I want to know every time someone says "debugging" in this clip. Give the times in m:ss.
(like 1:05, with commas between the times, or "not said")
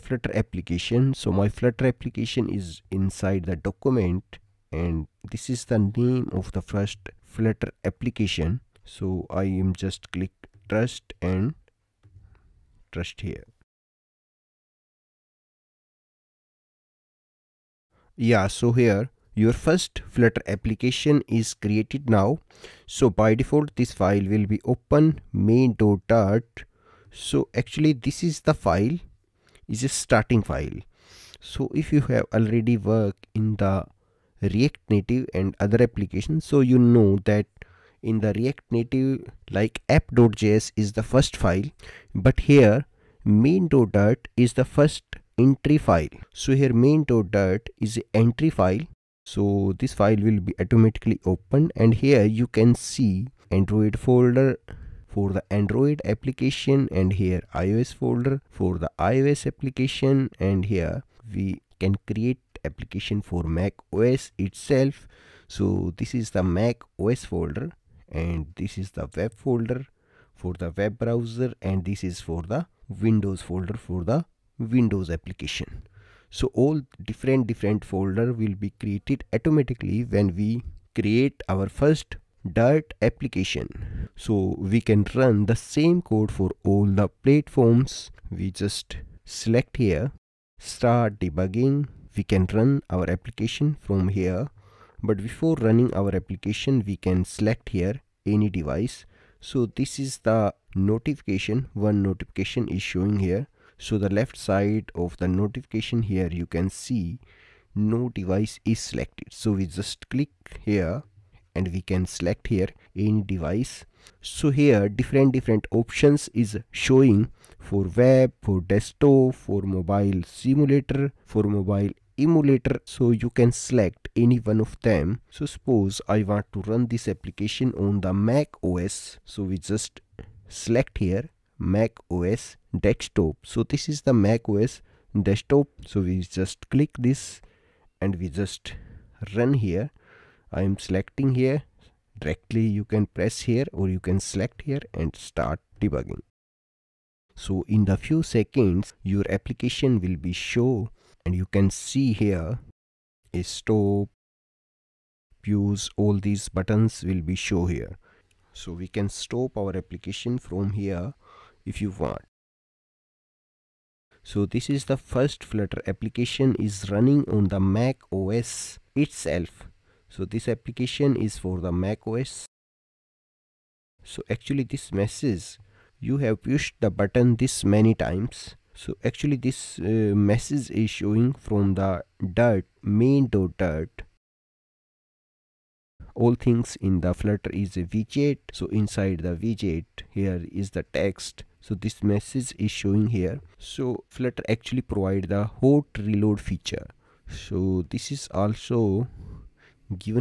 1:31, 2:25.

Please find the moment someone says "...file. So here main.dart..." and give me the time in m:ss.
0:45.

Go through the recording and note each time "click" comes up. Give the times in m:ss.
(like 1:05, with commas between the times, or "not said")
0:10, 1:50, 2:16.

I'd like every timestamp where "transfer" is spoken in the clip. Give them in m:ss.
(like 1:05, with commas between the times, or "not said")
not said.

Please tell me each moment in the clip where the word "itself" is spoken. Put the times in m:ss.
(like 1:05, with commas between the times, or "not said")
1:04, 2:48.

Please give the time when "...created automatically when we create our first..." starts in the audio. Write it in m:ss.
1:18.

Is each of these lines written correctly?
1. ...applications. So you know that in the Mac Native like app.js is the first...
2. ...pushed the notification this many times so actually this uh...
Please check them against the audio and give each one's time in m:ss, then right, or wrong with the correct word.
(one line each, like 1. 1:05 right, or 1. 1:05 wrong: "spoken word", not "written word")
1. 0:35 wrong: "React", not "Mac"
2. 2:56 wrong: "button", not "notification".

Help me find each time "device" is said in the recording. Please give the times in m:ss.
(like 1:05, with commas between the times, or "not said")
1:38, 1:48, 1:53.